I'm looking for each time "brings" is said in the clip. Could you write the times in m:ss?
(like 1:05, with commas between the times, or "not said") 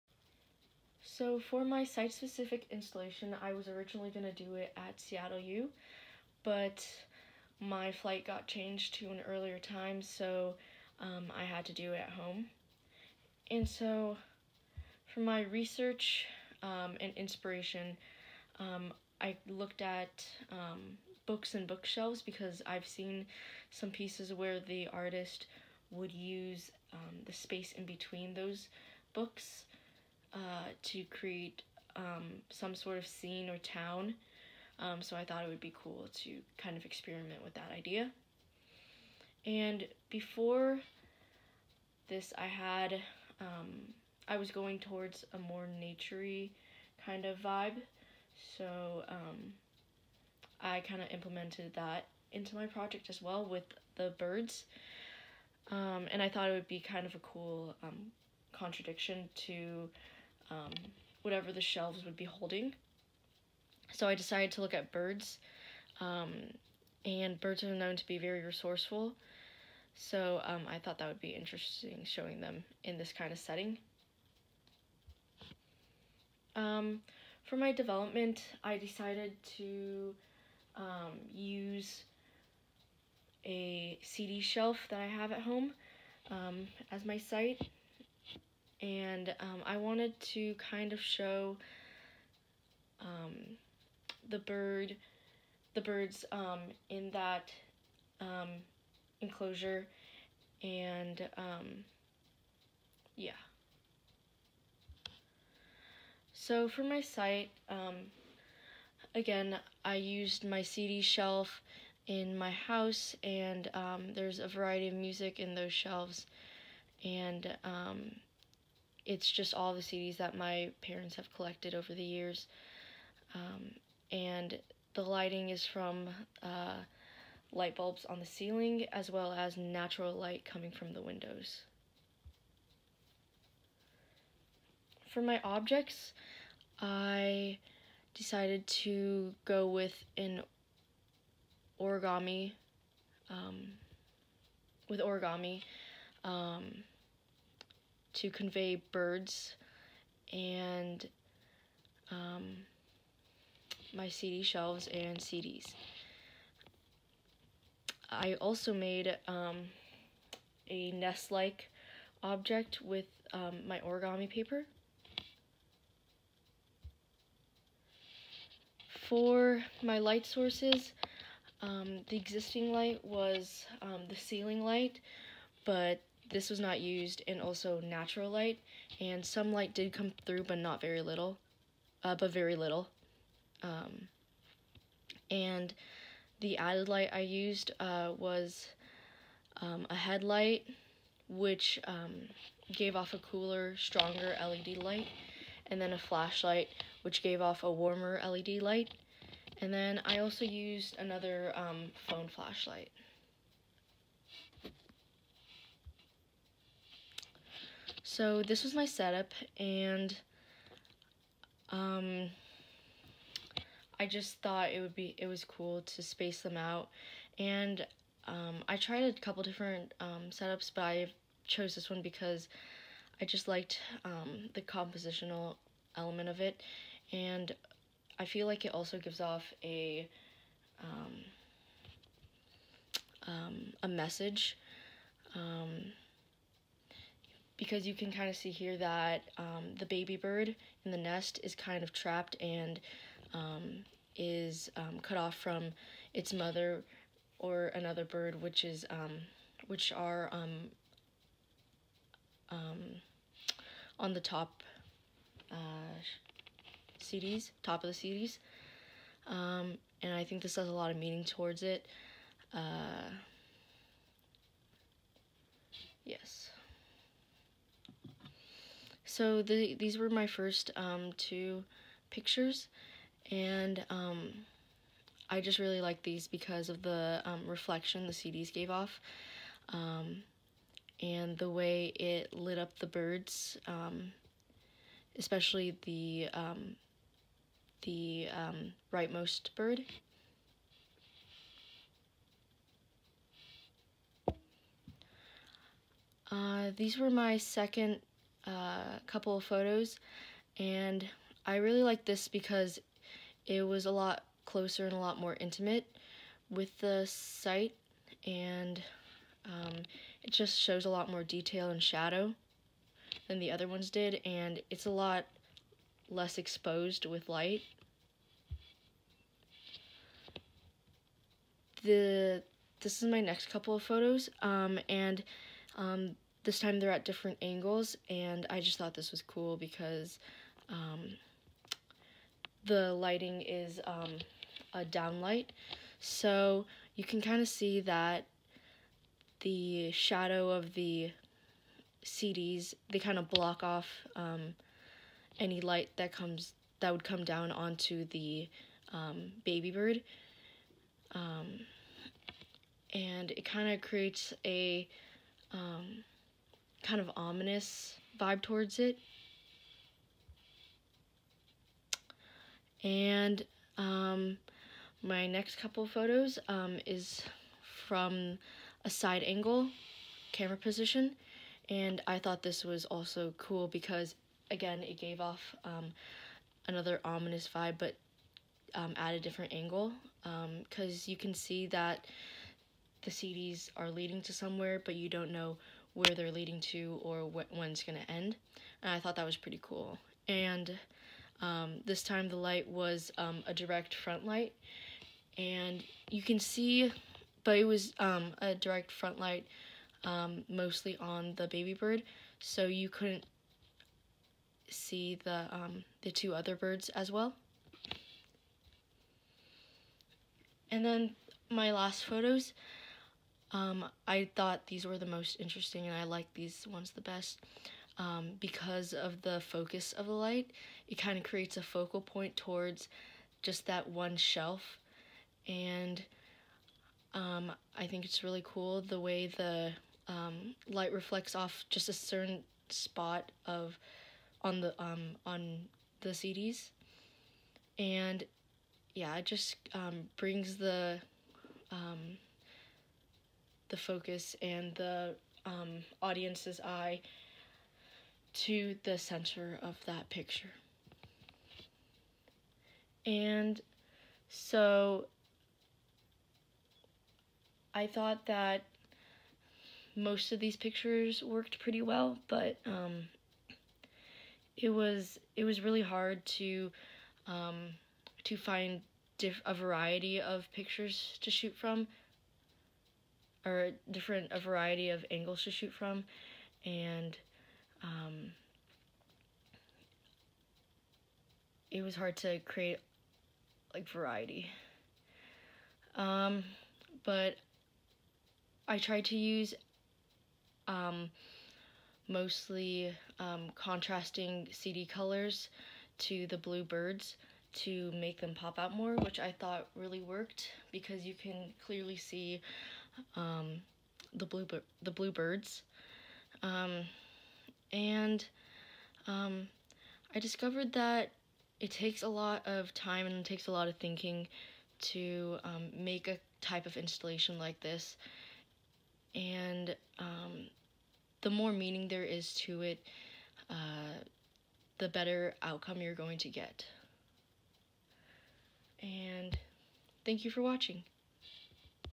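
7:20.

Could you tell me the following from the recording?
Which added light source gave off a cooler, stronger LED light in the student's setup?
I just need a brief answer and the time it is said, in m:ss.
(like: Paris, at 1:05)
headlight, at 3:09.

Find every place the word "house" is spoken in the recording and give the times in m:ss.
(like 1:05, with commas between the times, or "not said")
1:52.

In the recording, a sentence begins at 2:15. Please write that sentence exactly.
For my objects, I decided to go with an origami, um, with origami.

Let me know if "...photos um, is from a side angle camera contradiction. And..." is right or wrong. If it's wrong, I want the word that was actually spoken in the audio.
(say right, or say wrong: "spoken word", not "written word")
wrong: "position", not "contradiction".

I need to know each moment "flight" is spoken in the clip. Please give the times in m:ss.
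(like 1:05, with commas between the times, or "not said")
0:07.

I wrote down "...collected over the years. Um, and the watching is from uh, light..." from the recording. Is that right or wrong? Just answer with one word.
wrong.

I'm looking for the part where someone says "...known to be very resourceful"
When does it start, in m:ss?
1:07.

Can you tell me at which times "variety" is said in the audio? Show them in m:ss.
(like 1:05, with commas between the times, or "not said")
1:54, 7:49, 7:54, 8:03.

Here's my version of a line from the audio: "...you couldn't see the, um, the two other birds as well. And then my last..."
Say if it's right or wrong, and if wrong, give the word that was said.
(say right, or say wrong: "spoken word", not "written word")
right.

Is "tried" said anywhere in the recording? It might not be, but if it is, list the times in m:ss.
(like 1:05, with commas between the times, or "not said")
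3:38, 8:08.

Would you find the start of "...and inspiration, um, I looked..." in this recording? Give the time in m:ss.
0:16.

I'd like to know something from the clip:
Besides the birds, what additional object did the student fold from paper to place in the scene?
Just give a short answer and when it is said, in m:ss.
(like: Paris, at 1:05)
nest-like object, at 2:40.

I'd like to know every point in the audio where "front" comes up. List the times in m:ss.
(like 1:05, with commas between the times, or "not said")
6:33, 6:38.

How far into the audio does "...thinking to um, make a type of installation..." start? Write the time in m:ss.
8:33.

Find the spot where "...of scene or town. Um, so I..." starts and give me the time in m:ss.
0:32.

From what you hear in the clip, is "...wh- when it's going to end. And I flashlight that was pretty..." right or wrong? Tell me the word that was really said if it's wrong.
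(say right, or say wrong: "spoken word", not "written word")
wrong: "thought", not "flashlight".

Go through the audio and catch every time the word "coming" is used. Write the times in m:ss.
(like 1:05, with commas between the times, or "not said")
2:10.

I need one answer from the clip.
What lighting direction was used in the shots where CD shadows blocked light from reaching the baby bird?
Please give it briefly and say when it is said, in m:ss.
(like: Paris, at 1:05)
downlight, at 5:34.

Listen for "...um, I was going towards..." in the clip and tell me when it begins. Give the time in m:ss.
0:43.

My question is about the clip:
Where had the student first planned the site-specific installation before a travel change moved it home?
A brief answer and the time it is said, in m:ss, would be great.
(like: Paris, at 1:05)
Seattle U, at 0:04.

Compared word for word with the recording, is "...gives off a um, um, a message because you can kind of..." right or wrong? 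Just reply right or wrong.
right.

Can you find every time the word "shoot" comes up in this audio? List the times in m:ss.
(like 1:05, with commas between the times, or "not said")
7:51, 7:55.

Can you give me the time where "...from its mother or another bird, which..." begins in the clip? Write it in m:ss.
4:05.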